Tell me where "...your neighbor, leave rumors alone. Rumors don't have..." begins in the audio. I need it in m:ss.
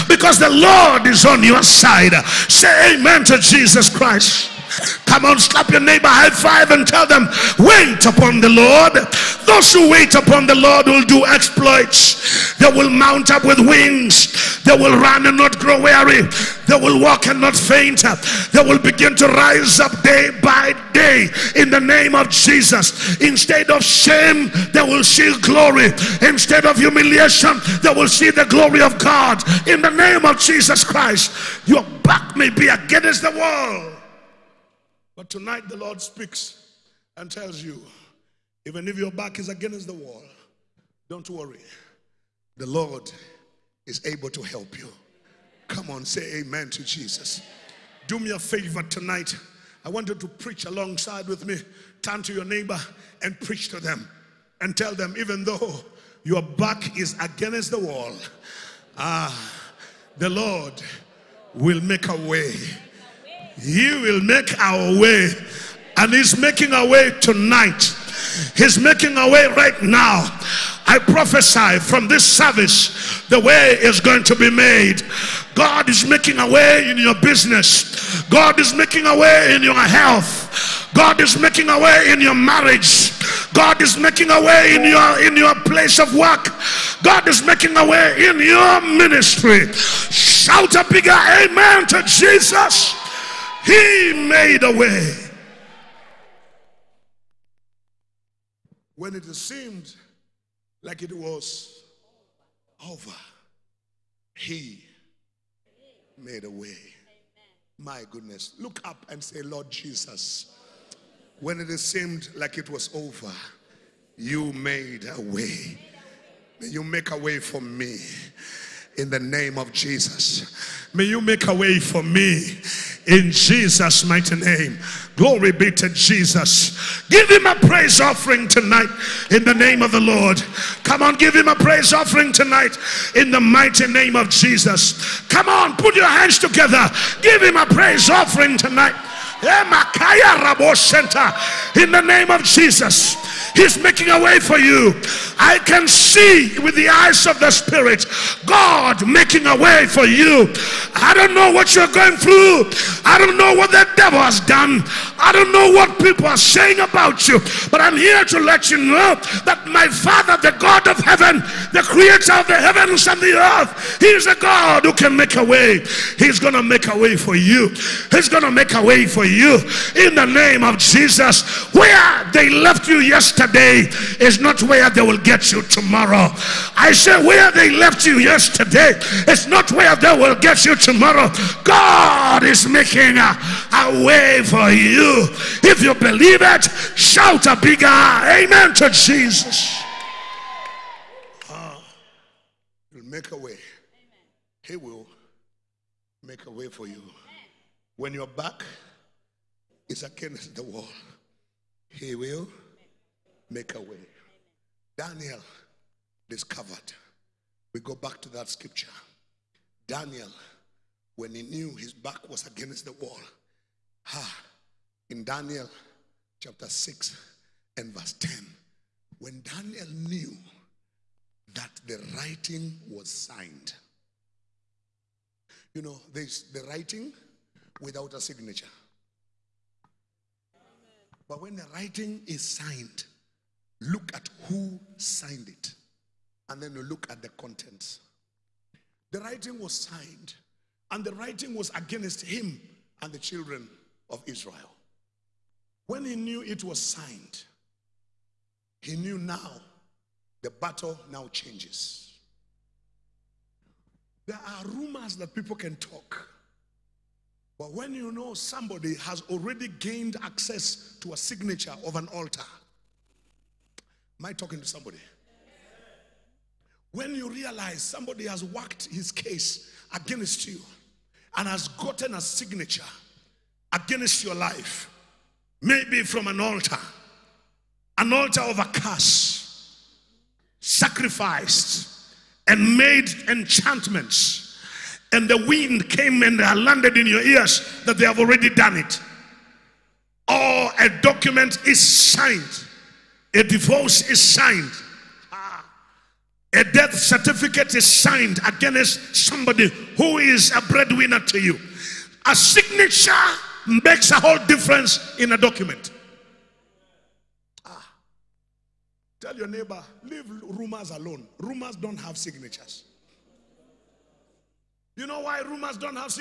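5:09.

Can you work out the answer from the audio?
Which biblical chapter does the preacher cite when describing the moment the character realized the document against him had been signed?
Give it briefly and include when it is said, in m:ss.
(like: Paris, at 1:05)
Daniel chapter 6, at 3:35.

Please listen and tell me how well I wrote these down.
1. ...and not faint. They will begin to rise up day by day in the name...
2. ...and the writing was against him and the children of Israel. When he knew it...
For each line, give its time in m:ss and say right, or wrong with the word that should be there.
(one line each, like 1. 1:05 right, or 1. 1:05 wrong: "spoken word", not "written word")
1. 0:17 right
2. 4:00 right.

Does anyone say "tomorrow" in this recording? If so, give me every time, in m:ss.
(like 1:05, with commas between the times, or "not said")
2:55, 3:00.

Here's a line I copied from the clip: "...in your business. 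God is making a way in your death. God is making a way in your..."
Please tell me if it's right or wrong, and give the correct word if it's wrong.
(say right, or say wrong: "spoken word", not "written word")
wrong: "health", not "death".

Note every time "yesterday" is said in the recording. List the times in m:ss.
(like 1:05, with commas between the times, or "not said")
2:52, 2:58.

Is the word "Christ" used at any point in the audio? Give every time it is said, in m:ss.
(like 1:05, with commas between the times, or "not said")
0:03, 0:30.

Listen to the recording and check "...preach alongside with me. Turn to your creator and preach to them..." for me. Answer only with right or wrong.
wrong.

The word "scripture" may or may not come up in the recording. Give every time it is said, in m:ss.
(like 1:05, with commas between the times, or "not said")
3:28.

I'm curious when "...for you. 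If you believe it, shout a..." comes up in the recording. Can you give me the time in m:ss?
3:04.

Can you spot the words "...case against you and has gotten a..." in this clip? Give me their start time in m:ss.
4:29.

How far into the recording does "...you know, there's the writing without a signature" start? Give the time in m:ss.
3:45.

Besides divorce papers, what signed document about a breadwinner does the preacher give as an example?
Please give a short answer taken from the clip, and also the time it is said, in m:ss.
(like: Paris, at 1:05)
death certificate, at 4:56.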